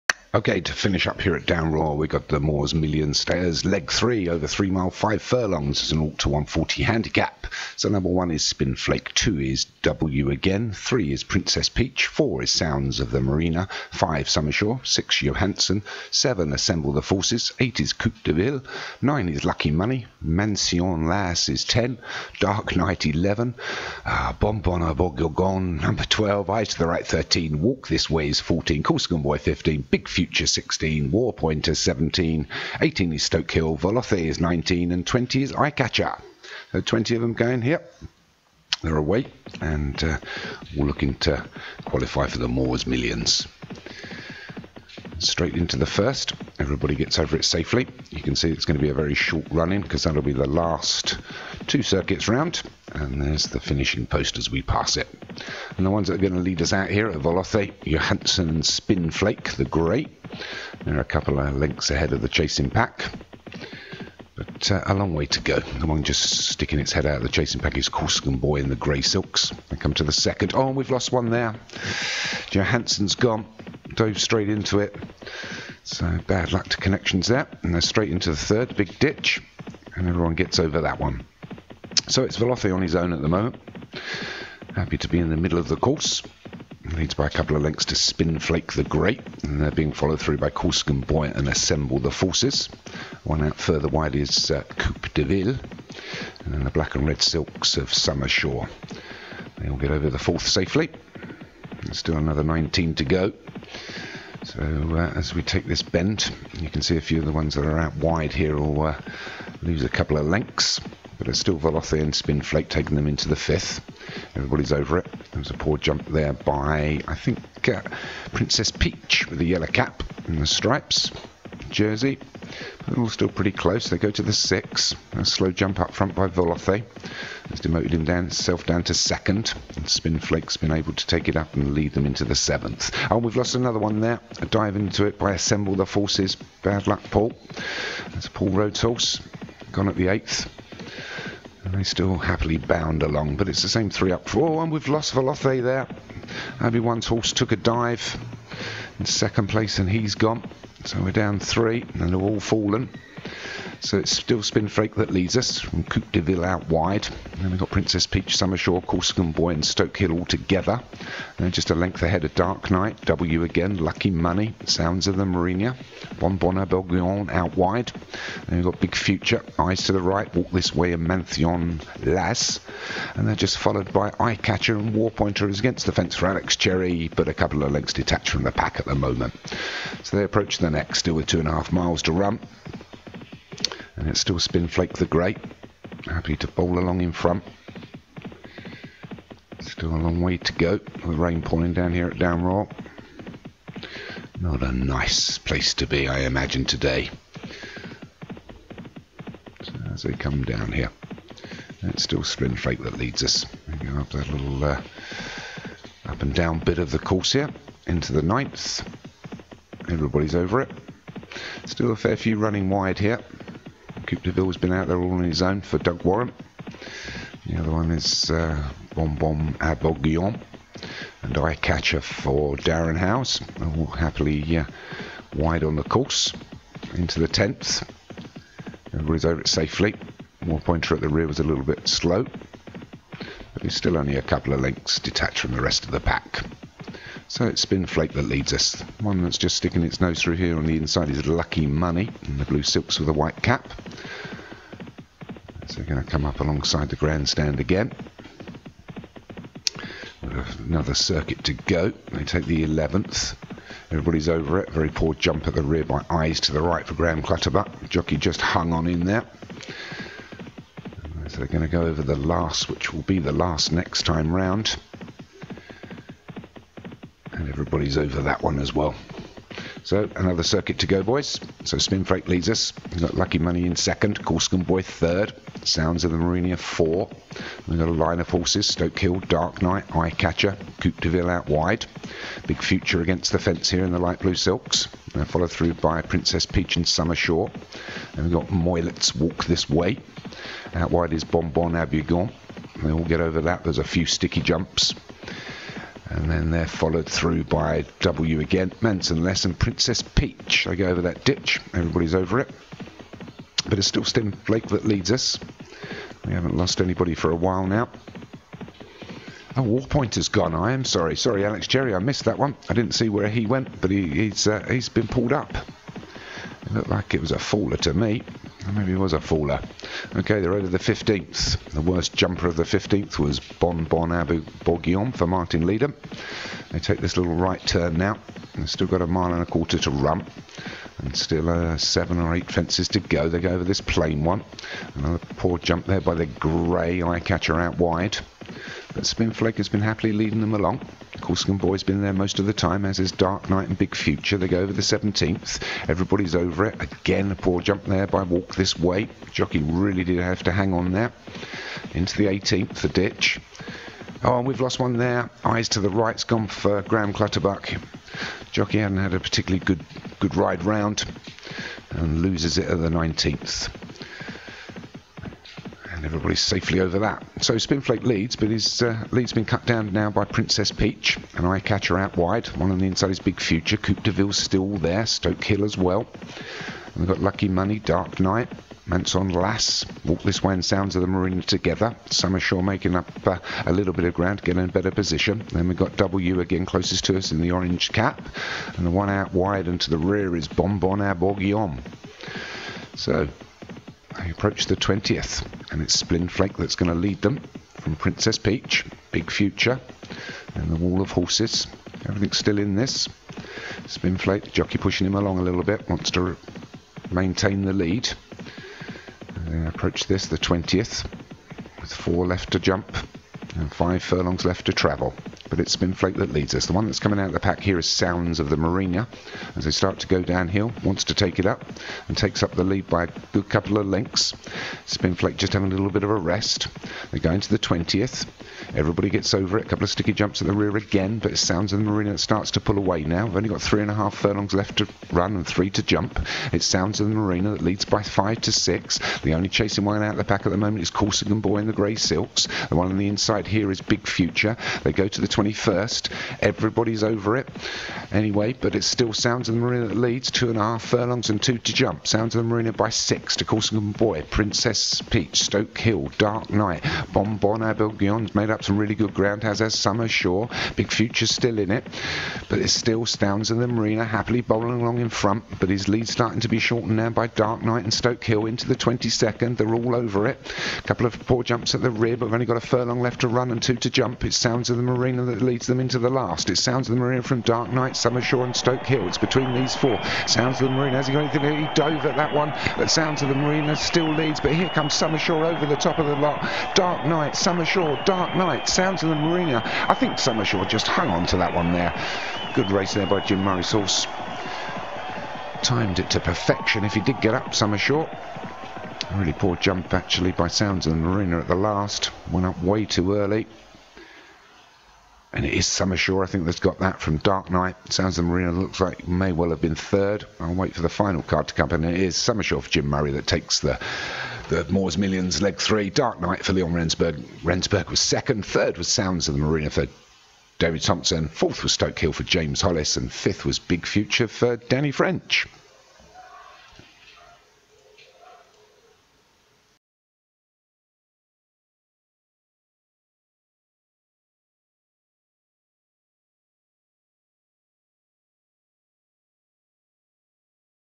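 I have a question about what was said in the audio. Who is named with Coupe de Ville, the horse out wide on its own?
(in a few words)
Doug Warren.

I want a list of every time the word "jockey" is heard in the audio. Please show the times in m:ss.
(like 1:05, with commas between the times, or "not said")
4:17, 5:49, 5:58, 6:44.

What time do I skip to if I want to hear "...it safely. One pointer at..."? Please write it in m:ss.
3:49.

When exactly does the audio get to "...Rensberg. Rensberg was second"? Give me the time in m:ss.
8:36.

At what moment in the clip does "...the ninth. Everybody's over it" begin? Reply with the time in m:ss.
3:28.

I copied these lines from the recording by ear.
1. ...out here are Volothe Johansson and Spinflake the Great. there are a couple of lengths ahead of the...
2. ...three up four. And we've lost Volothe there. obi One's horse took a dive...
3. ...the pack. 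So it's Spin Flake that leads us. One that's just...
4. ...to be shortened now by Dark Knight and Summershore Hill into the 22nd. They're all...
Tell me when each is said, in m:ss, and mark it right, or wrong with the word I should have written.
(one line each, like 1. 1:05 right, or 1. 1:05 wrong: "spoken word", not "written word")
1. 0:56 right
2. 2:23 right
3. 3:55 right
4. 7:46 wrong: "Stoke", not "Summershore".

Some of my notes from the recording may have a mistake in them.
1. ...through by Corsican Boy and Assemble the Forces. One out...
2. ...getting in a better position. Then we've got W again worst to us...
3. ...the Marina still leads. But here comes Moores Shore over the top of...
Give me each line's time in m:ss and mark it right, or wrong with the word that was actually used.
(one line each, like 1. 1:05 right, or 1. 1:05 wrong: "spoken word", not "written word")
1. 1:30 right
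2. 6:24 wrong: "closest", not "worst"
3. 8:03 wrong: "Summer", not "Moores".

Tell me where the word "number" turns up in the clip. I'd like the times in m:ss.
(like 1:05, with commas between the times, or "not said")
0:07, 0:25.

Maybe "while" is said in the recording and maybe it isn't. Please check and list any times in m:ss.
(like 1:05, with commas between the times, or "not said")
5:07.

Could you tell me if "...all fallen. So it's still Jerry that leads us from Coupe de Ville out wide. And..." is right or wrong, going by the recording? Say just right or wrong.
wrong.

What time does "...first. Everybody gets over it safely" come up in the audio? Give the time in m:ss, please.
0:45.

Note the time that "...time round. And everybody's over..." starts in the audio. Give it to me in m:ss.
4:24.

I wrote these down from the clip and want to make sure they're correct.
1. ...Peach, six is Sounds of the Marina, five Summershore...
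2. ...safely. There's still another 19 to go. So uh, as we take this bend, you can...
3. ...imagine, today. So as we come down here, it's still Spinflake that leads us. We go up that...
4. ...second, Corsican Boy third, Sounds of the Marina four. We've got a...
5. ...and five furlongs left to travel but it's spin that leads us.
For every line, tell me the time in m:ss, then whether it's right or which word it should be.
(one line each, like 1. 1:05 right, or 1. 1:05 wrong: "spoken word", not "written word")
1. 0:11 wrong: "four", not "six"
2. 1:40 right
3. 3:16 right
4. 4:33 right
5. 6:53 right.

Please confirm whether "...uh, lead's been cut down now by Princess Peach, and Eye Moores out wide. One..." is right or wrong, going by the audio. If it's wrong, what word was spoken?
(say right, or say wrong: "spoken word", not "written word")
wrong: "Catcher", not "Moores".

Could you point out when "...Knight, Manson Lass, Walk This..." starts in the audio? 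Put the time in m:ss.
6:18.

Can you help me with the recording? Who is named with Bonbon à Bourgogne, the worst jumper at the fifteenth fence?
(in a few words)
Martin Leader.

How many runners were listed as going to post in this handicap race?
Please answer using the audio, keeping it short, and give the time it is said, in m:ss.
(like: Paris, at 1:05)
20, at 0:36.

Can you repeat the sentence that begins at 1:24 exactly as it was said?
Happy to be in the middle of the course.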